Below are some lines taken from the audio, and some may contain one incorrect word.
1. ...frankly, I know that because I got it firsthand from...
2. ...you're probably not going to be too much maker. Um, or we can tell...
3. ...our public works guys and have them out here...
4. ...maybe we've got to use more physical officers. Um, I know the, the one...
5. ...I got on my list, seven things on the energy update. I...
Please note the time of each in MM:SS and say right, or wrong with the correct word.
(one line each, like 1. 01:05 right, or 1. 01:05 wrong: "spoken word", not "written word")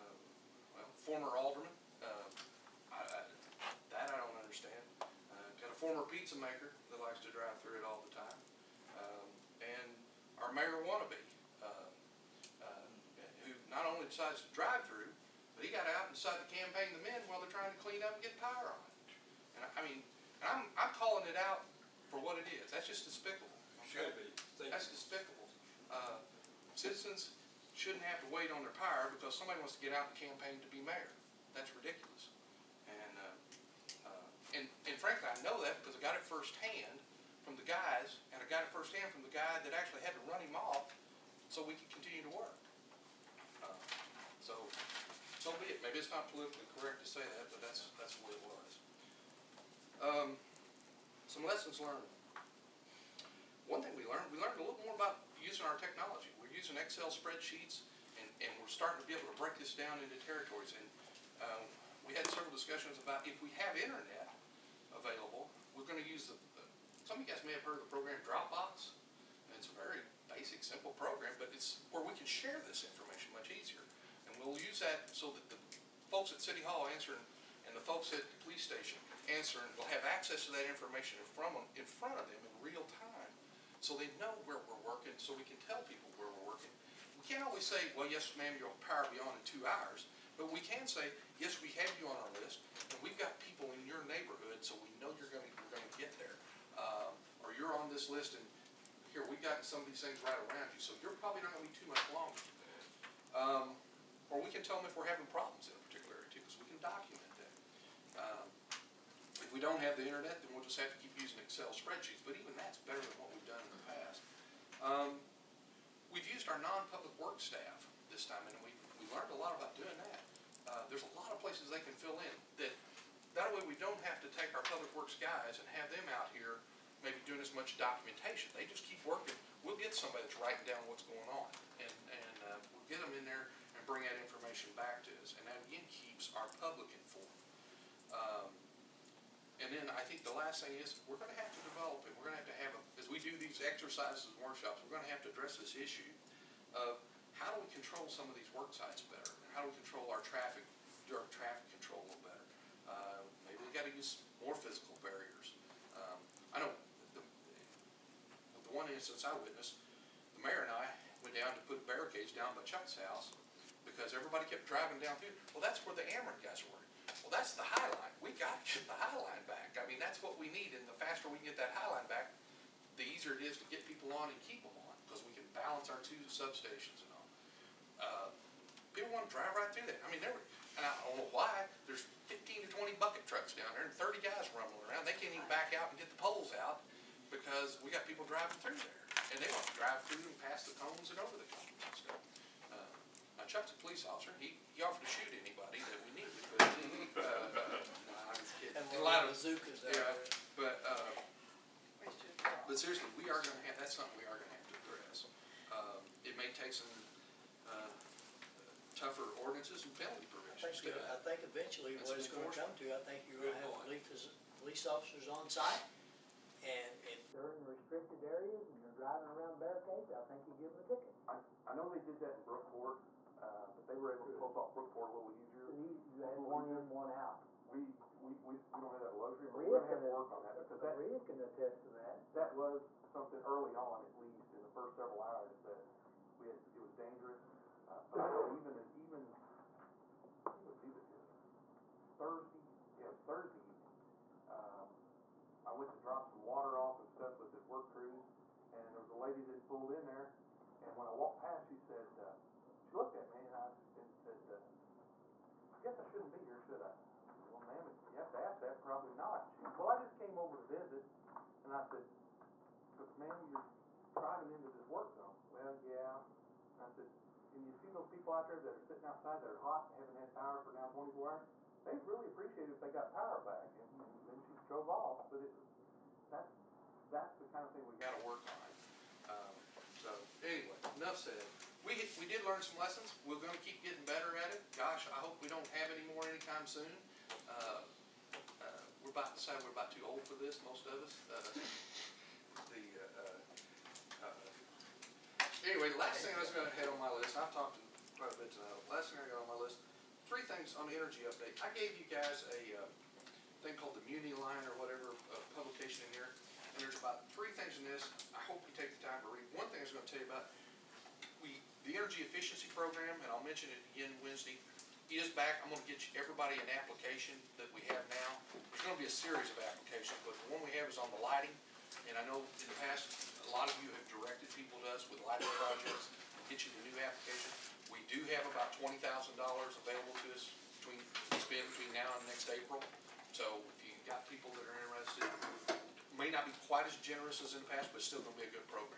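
1. 00:34 right
2. 01:41 wrong: "longer", not "maker"
3. 02:04 right
4. 02:33 wrong: "barriers", not "officers"
5. 04:59 wrong: "three", not "seven".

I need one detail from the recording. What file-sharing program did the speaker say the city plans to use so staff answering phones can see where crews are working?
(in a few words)
Dropbox.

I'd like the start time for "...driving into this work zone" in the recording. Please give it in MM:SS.
04:24.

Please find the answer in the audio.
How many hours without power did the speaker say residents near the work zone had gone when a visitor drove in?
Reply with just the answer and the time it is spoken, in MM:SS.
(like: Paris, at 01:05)
24, at 04:30.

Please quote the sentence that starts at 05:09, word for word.
One thing I was going to tell you about, we the energy efficiency program, and I'll mention it again Wednesday, is back.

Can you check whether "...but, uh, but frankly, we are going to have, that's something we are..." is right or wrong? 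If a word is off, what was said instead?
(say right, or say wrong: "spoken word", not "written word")
wrong: "seriously", not "frankly".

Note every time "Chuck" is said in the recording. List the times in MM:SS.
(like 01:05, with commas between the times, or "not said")
02:42, 03:13.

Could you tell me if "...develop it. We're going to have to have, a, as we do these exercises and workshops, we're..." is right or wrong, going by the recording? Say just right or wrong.
right.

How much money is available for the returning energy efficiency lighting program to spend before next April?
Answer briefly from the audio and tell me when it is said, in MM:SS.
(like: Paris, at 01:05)
$20,000, at 05:28.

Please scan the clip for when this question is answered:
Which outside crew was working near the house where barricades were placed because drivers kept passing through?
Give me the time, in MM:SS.
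02:46.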